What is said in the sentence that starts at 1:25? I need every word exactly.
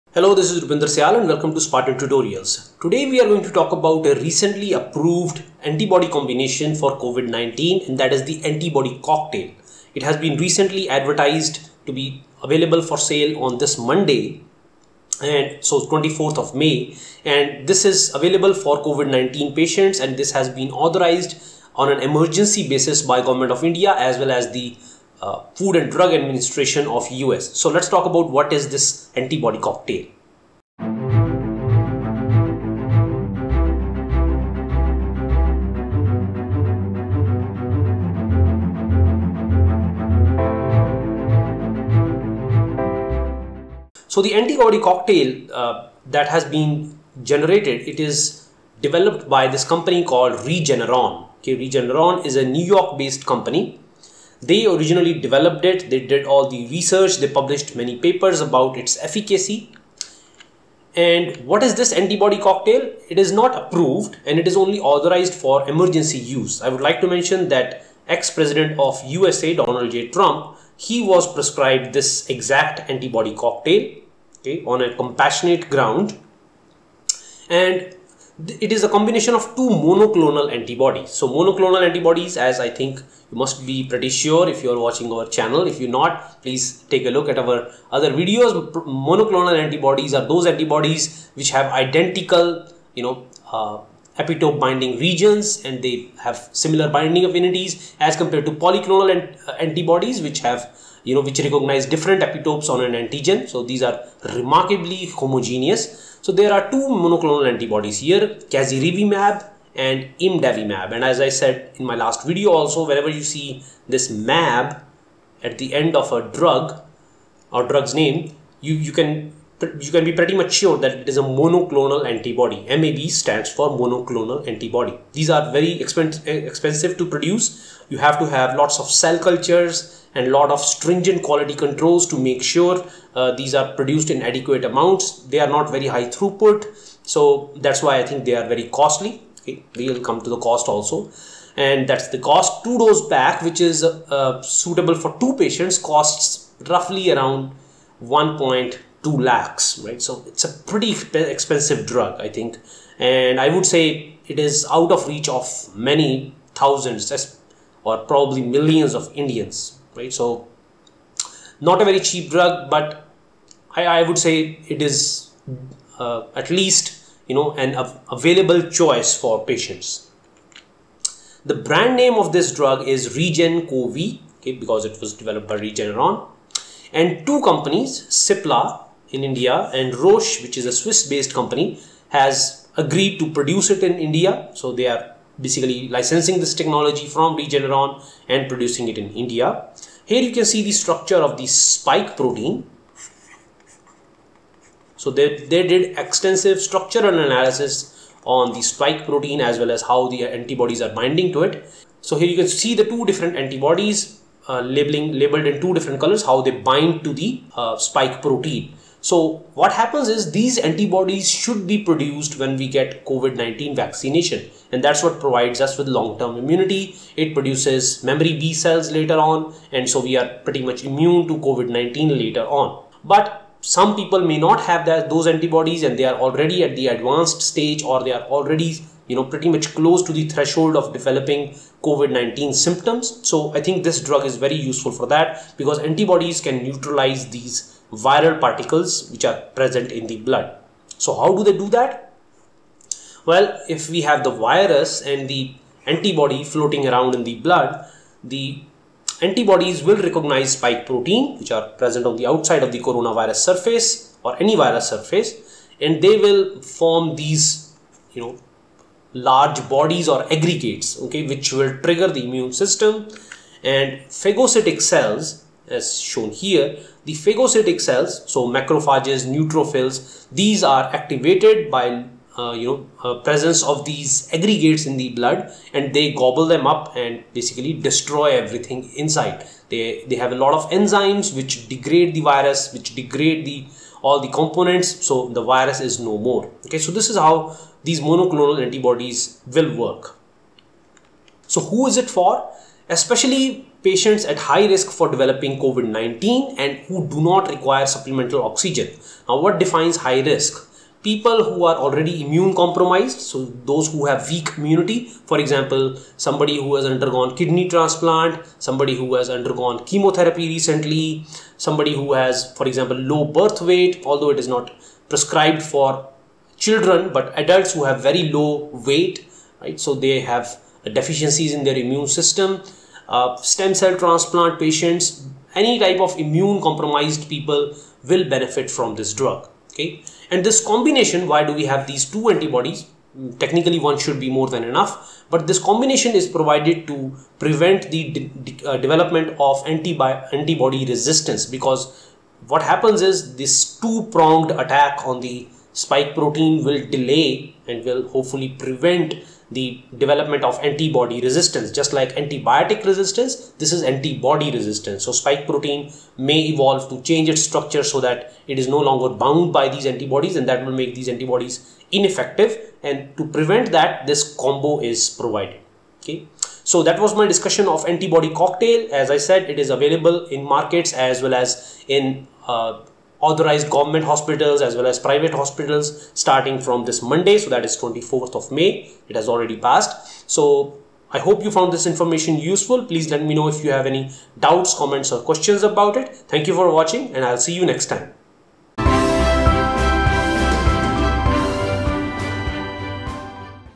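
If you're not, please take a look at our other videos.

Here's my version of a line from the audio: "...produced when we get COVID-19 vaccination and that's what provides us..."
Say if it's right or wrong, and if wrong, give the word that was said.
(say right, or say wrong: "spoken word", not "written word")
right.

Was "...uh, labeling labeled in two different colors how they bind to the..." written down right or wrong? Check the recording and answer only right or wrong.
right.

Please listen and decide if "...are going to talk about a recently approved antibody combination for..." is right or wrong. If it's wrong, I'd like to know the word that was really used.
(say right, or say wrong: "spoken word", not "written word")
right.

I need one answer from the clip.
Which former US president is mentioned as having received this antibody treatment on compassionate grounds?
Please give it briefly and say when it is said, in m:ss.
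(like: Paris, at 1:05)
Donald J. Trump, at 1:09.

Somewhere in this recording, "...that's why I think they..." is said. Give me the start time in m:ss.
2:17.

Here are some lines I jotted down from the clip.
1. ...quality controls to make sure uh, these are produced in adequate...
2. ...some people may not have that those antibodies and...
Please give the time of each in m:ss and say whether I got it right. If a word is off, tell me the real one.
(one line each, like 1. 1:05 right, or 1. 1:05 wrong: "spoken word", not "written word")
1. 2:11 right
2. 3:43 right.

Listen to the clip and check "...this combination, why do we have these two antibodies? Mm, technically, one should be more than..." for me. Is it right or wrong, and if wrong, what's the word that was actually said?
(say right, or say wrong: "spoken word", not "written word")
right.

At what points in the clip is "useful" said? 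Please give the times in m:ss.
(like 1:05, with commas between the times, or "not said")
3:54, 6:22.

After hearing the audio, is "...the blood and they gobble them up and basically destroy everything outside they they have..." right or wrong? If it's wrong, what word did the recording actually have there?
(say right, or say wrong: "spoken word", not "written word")
wrong: "inside", not "outside".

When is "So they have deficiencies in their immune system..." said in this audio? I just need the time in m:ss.
5:19.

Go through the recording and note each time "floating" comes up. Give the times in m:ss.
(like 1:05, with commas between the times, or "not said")
4:06.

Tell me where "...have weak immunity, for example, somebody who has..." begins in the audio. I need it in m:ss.
5:04.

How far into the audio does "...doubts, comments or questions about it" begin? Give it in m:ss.
6:24.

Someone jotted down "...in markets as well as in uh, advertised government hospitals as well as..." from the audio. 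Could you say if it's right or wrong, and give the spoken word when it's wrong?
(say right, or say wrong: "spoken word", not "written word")
wrong: "authorized", not "advertised".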